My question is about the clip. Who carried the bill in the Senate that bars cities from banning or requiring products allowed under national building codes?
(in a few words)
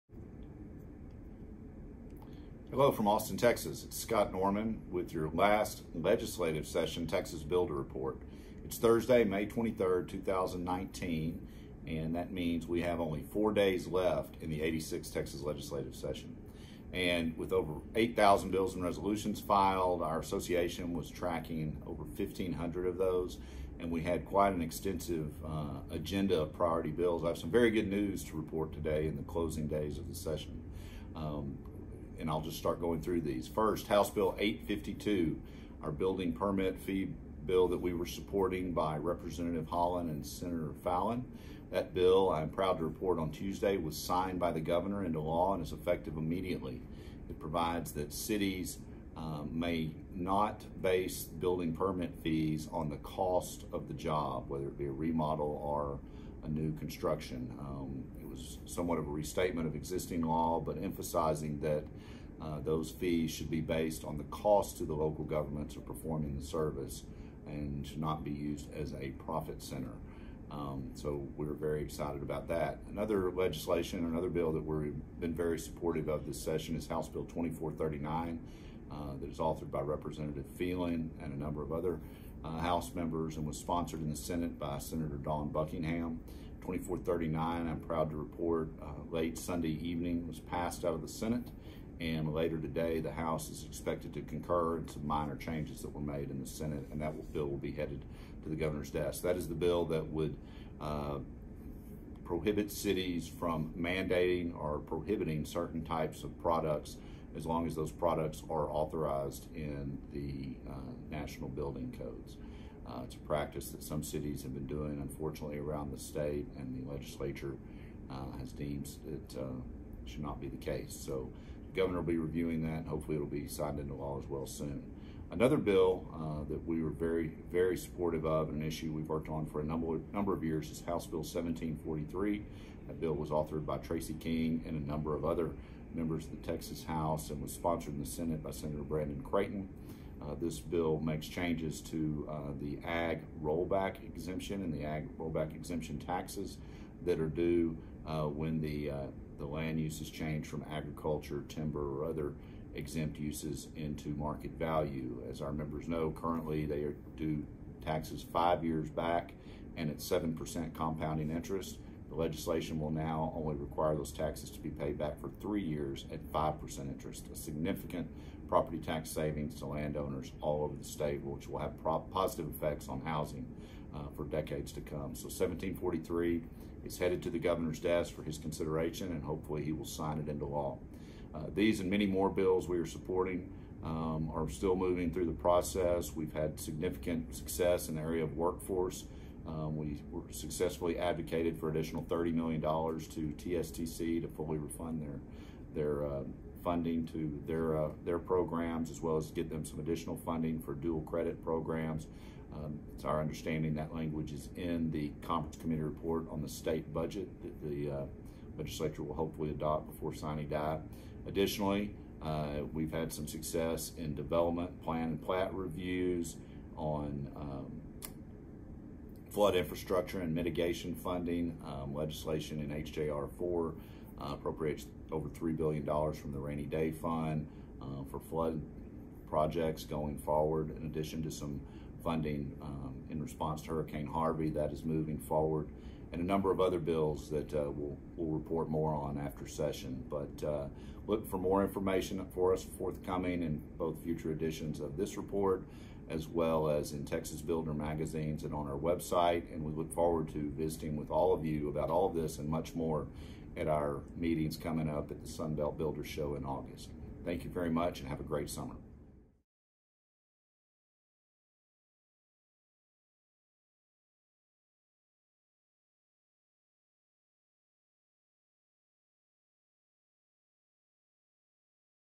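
Dawn Buckingham.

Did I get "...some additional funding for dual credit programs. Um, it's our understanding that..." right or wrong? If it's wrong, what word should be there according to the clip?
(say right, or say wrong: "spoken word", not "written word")
right.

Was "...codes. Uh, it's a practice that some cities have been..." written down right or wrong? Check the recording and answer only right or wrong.
right.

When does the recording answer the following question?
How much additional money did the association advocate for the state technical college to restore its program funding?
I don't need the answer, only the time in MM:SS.
03:12.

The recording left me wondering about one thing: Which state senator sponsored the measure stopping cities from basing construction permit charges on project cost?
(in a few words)
Senator Fallon.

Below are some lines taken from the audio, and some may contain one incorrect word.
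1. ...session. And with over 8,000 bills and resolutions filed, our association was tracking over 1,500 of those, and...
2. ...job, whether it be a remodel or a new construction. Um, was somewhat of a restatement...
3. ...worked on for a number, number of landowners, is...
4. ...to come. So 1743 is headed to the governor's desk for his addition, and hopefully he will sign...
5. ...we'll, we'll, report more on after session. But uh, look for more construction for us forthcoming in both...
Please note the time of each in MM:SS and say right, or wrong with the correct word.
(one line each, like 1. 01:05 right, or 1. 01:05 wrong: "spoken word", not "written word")
1. 00:15 right
2. 00:53 right
3. 02:09 wrong: "years", not "landowners"
4. 02:54 wrong: "consideration", not "addition"
5. 03:57 wrong: "information", not "construction".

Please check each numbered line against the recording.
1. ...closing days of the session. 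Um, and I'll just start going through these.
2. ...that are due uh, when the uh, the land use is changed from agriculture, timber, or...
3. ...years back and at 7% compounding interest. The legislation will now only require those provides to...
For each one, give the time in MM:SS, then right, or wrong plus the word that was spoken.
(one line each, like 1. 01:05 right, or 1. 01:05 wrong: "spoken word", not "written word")
1. 00:29 right
2. 02:27 right
3. 02:38 wrong: "taxes", not "provides".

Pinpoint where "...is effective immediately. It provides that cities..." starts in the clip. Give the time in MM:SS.
00:45.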